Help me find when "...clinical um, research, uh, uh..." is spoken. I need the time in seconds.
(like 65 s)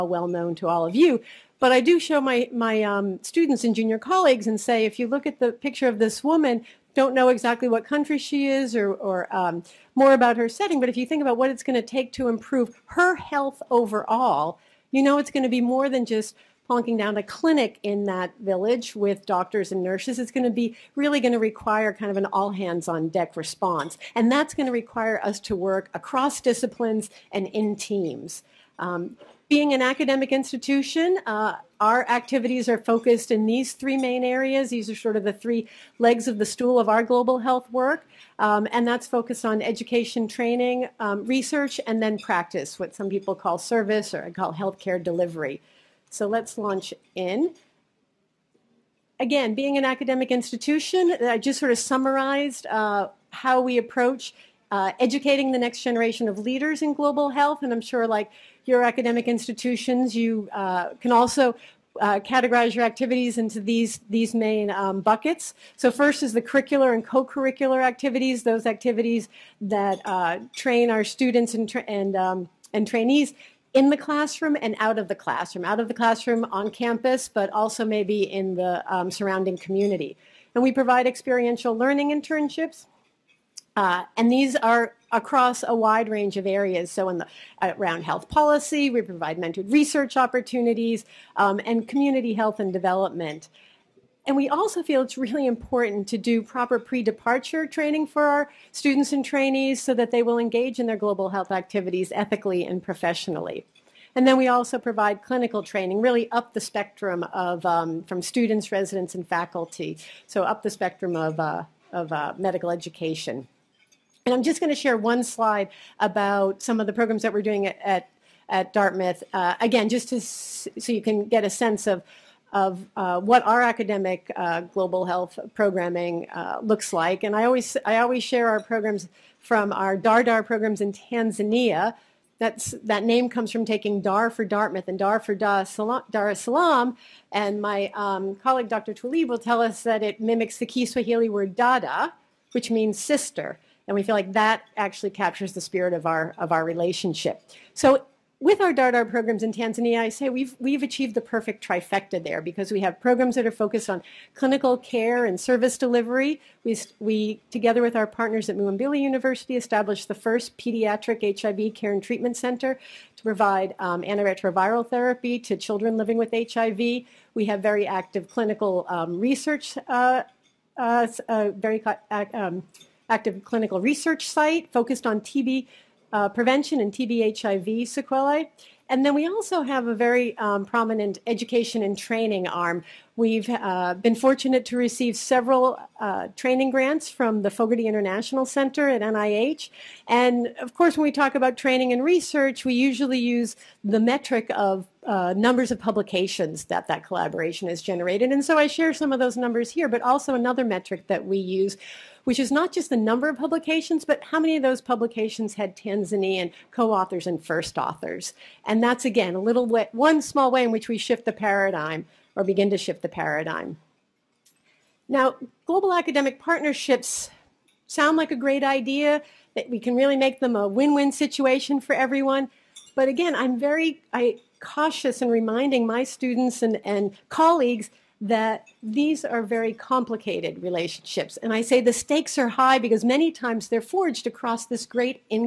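168 s.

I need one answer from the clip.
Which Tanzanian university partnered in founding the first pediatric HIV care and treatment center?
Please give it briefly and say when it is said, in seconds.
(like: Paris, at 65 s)
Muhimbili University, at 158 s.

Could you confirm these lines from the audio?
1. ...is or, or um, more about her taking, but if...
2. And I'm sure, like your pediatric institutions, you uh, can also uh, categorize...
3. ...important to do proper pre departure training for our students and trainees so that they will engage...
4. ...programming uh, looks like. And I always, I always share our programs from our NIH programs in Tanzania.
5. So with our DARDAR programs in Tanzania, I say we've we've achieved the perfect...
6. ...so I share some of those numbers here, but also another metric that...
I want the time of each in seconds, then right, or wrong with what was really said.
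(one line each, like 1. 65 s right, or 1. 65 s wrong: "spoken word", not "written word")
1. 8 s wrong: "setting", not "taking"
2. 57 s wrong: "academic", not "pediatric"
3. 95 s right
4. 125 s wrong: "DARDAR", not "NIH"
5. 147 s right
6. 198 s right.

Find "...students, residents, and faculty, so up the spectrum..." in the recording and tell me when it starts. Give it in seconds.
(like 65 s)
108 s.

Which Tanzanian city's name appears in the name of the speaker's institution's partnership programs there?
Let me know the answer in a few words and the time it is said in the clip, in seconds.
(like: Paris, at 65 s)
Dar es Salaam, at 135 s.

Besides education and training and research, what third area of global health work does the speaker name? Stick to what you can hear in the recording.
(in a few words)
Practice.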